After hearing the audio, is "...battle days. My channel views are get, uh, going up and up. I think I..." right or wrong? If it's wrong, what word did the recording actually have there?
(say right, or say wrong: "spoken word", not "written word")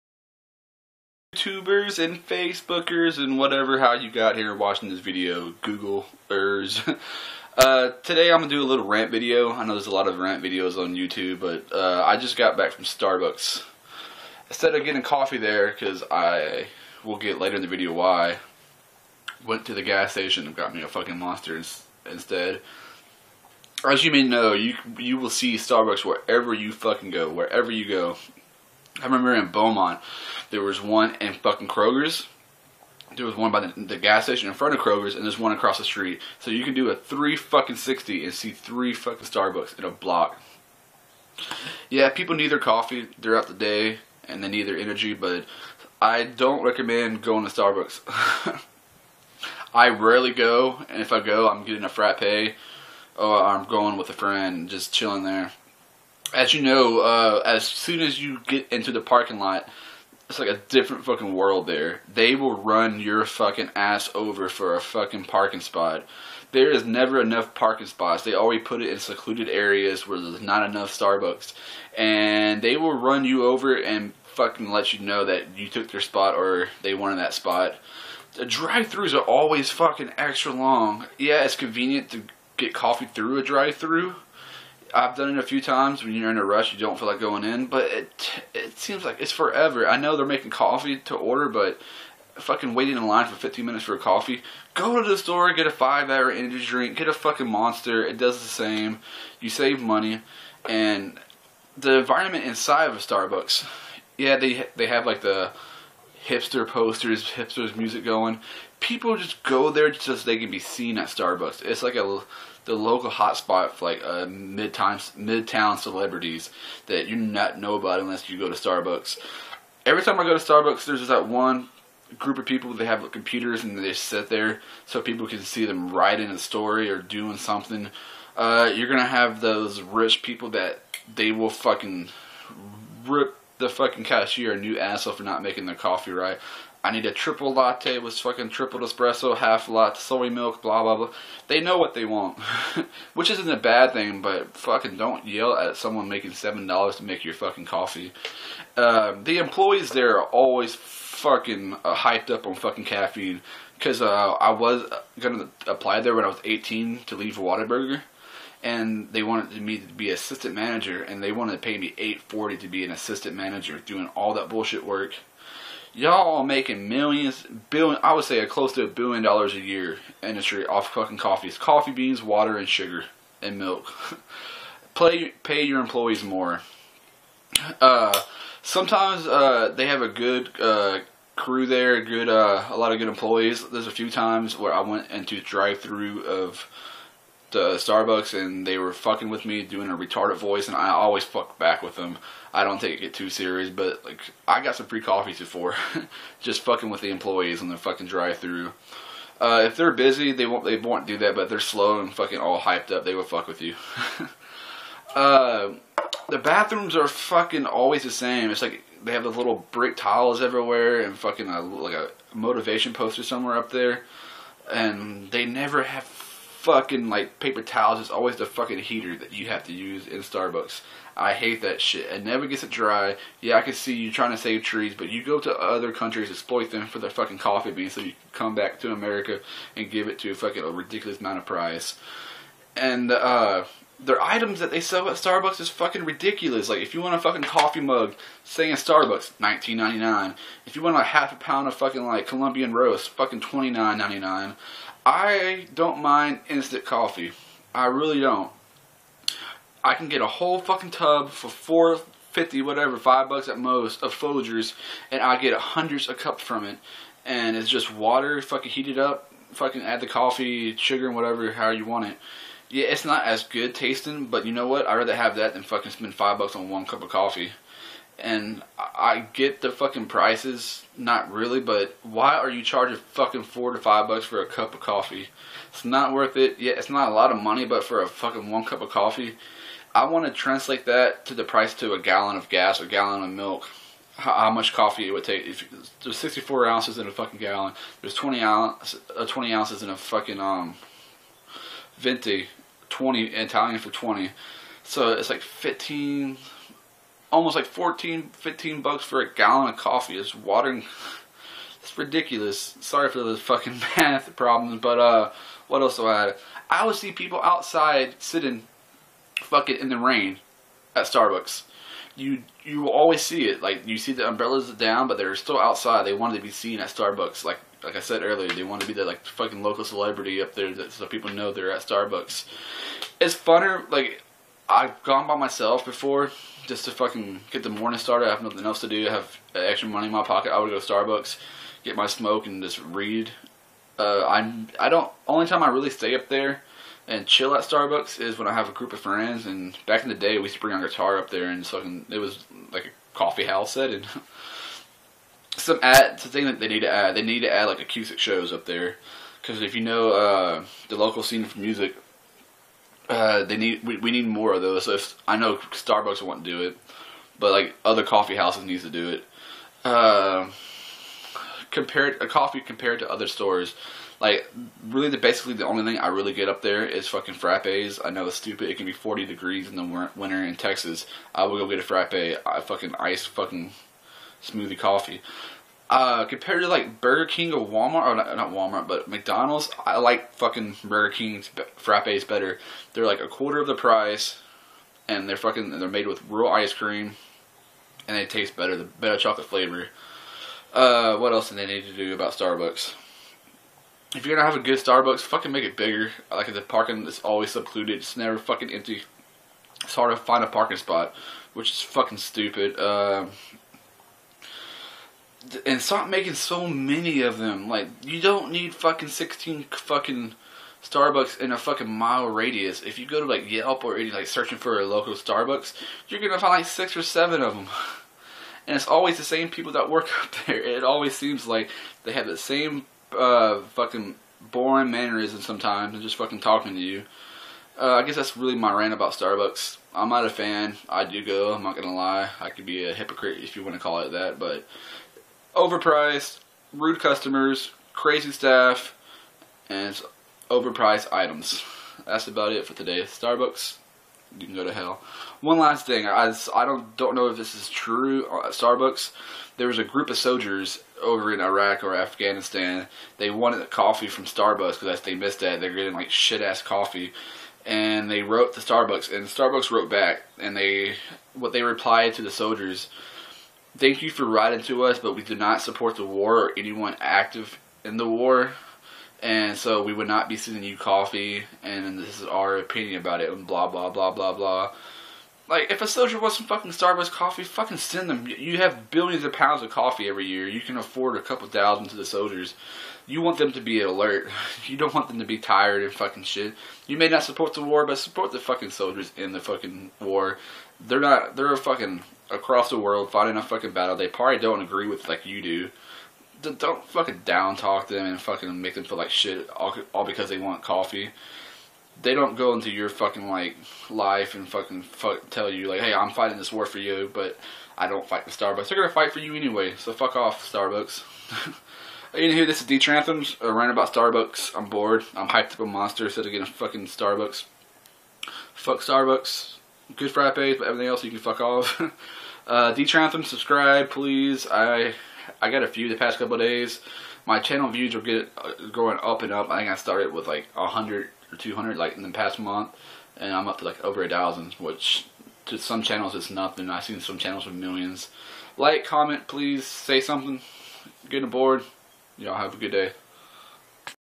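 wrong: "couple", not "battle".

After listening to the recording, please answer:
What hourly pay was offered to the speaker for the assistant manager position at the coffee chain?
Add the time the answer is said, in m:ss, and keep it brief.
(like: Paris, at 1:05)
$8.40, at 2:41.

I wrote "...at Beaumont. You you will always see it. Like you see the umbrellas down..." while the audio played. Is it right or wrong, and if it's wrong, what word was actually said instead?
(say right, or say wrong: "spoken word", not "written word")
wrong: "Starbucks", not "Beaumont".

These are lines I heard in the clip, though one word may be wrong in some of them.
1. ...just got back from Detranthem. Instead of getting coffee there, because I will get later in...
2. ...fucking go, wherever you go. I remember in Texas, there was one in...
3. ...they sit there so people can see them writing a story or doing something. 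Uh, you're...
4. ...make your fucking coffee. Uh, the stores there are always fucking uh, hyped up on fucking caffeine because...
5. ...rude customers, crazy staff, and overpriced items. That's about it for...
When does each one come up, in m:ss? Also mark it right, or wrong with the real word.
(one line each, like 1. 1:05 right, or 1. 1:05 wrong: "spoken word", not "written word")
1. 0:12 wrong: "Starbucks", not "Detranthem"
2. 0:26 wrong: "Beaumont", not "Texas"
3. 2:03 right
4. 2:27 wrong: "employees", not "stores"
5. 7:16 right.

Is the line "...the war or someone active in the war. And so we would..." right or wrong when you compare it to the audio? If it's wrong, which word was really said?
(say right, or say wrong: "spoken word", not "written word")
wrong: "anyone", not "someone".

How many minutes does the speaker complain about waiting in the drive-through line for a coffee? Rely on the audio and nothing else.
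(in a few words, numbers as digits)
15.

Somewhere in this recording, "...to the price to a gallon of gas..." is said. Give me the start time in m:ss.
4:41.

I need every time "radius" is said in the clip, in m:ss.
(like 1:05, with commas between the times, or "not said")
6:52.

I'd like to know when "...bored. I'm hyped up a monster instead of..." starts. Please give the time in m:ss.
8:34.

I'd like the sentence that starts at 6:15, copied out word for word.
Uh, compared to like Burger King or Walmart, or not, not Walmart, but McDonald's, I like fucking Burger King's frappes better.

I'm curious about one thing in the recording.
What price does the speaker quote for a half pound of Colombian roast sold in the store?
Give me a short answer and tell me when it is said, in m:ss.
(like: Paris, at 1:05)
$29.99, at 4:03.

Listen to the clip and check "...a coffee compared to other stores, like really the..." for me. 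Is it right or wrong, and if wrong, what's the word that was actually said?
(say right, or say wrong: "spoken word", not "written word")
right.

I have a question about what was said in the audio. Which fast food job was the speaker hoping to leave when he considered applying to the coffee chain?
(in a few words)
Whataburger.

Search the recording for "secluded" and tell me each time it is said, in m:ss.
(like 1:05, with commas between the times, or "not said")
1:08, 6:37.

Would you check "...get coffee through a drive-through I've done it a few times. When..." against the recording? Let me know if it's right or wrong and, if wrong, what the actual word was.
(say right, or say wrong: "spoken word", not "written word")
right.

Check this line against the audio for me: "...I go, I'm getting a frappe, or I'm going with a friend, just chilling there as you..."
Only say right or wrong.
right.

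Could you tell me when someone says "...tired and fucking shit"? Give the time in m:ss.
8:05.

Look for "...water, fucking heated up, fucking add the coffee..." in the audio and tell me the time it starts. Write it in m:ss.
4:17.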